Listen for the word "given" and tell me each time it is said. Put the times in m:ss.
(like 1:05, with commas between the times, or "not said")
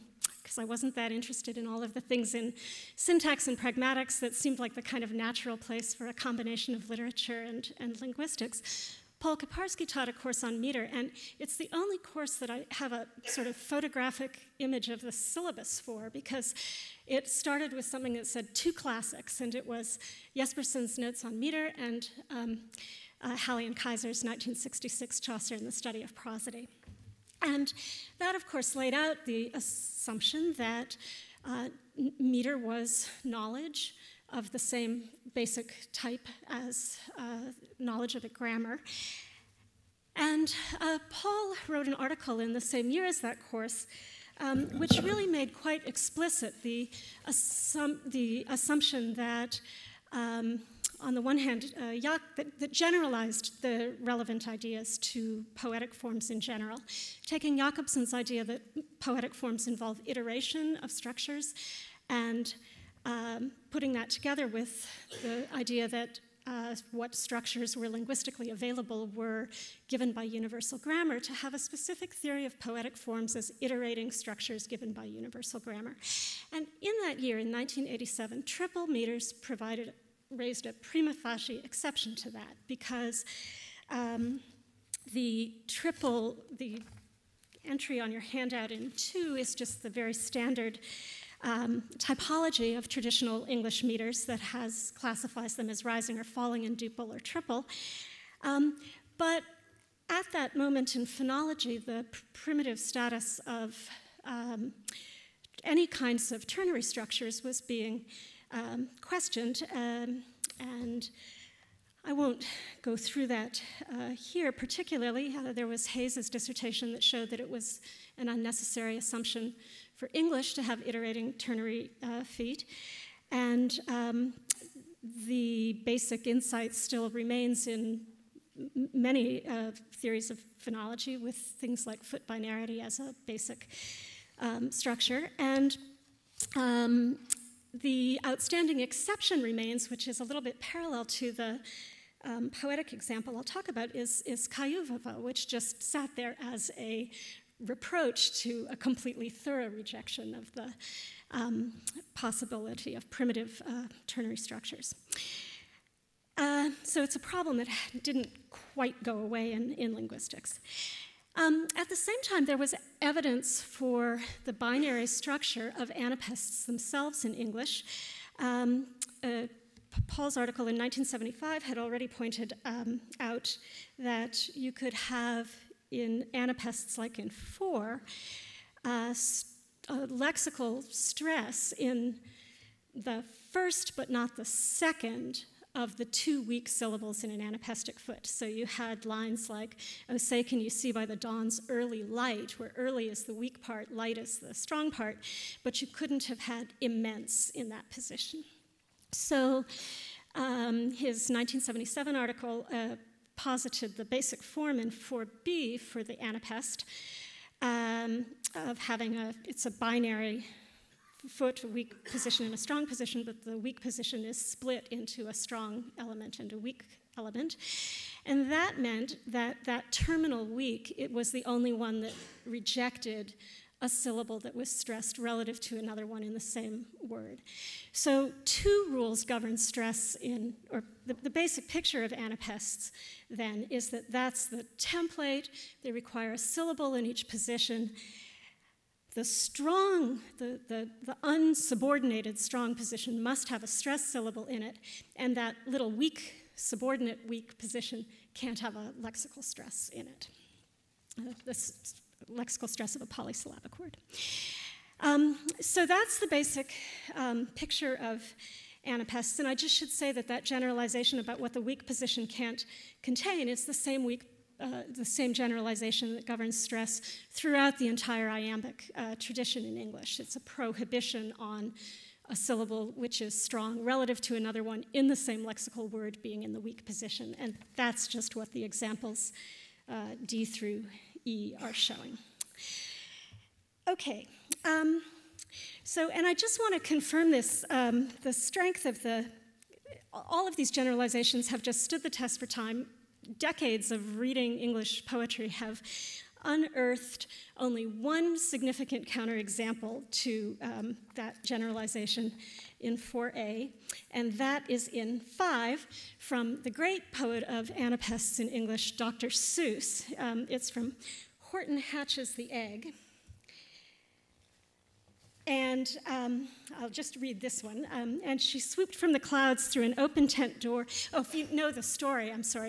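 1:09, 1:14.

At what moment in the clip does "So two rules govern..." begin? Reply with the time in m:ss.
3:47.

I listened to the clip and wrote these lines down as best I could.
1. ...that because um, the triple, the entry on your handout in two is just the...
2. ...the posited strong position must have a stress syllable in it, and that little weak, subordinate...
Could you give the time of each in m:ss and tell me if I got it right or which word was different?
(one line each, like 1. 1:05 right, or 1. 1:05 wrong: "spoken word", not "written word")
1. 1:22 right
2. 4:01 wrong: "unsubordinated", not "posited".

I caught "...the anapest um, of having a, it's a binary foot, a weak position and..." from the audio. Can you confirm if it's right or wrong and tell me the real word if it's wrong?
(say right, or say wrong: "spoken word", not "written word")
right.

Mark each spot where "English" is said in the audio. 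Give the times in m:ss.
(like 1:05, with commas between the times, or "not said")
1:33, 2:00, 2:47, 4:29, 4:54, 5:08.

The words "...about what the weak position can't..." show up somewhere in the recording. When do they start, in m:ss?
4:21.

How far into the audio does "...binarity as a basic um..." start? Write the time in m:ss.
2:12.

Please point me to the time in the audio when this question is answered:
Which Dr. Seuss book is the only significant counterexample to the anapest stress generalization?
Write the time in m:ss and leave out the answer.
5:11.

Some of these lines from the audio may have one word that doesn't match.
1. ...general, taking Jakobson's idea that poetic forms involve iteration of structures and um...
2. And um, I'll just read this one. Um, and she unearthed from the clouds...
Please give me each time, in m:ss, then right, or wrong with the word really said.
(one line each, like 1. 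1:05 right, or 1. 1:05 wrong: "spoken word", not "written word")
1. 0:56 right
2. 5:15 wrong: "swooped", not "unearthed".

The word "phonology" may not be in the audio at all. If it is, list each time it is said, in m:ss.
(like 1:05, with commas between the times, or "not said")
1:41, 2:10.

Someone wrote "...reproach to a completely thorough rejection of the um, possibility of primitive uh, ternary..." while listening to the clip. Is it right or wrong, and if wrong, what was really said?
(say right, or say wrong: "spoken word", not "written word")
right.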